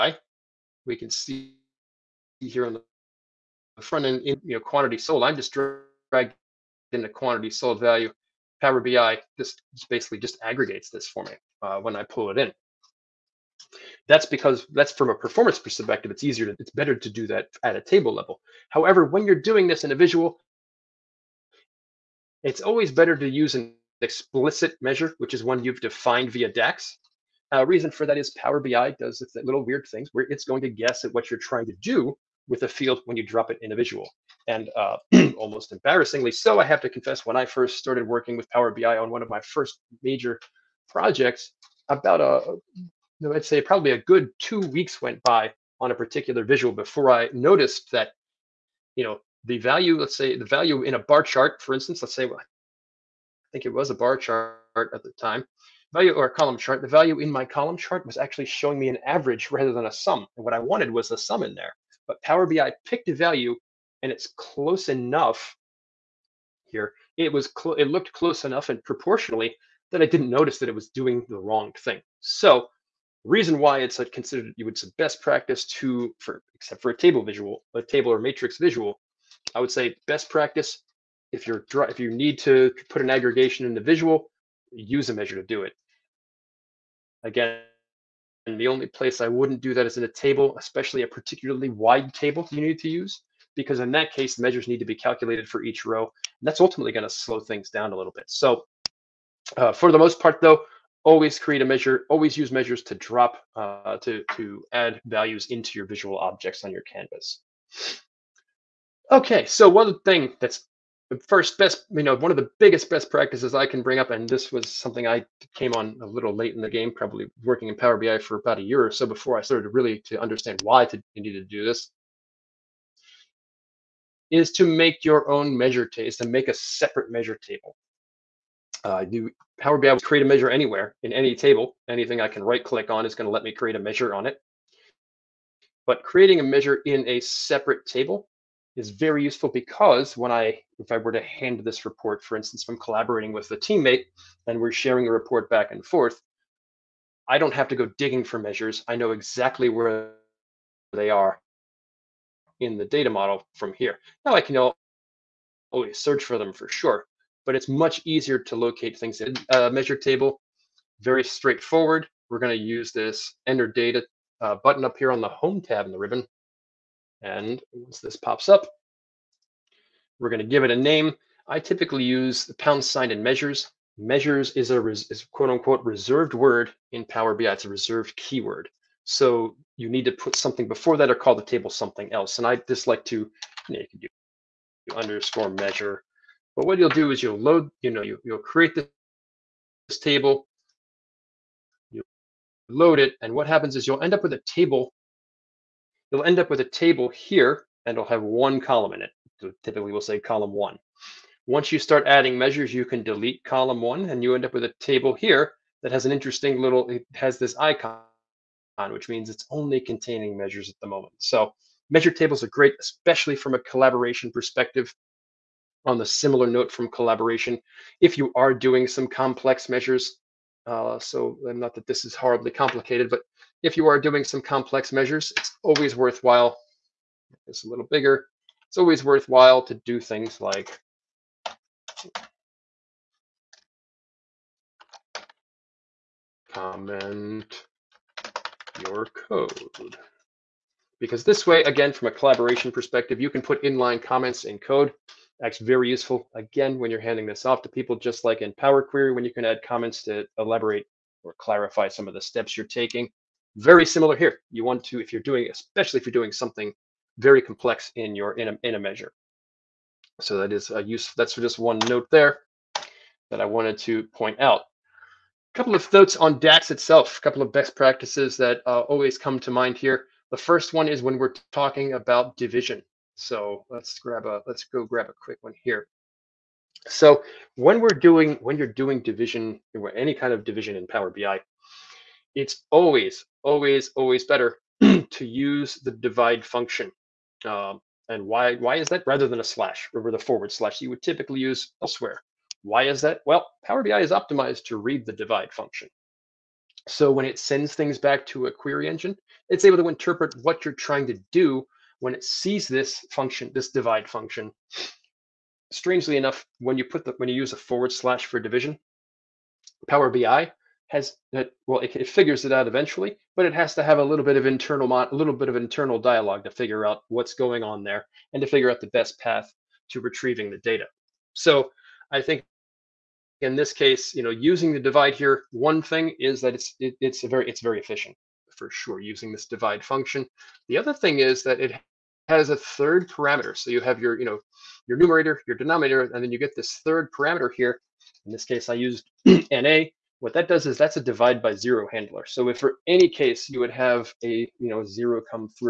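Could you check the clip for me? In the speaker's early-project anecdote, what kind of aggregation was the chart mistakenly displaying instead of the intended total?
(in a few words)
an average.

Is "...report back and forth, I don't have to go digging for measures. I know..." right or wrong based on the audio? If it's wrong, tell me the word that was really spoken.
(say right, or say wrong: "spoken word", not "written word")
right.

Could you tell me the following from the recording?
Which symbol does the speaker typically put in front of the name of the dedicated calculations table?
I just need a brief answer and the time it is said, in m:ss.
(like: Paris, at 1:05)
pound sign, at 2:52.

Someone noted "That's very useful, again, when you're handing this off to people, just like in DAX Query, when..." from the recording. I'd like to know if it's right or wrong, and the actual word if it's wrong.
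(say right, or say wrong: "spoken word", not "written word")
wrong: "Power", not "DAX".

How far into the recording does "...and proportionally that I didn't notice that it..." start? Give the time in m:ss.
1:08.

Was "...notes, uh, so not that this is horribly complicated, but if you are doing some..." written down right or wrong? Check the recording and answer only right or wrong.
wrong.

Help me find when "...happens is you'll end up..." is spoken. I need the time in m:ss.
3:13.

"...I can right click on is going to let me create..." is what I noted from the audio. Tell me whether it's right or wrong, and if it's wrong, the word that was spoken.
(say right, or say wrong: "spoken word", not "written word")
right.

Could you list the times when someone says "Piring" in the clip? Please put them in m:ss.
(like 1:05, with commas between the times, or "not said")
not said.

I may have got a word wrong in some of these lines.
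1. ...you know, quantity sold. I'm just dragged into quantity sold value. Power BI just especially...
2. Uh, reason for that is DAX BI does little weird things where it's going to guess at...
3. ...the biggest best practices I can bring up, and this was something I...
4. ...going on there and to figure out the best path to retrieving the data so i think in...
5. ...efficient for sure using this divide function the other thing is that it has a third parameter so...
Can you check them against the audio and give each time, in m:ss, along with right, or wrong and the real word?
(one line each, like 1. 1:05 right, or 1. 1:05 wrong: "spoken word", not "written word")
1. 0:04 wrong: "basically", not "especially"
2. 0:27 wrong: "Power", not "DAX"
3. 1:52 right
4. 5:17 right
5. 5:27 right.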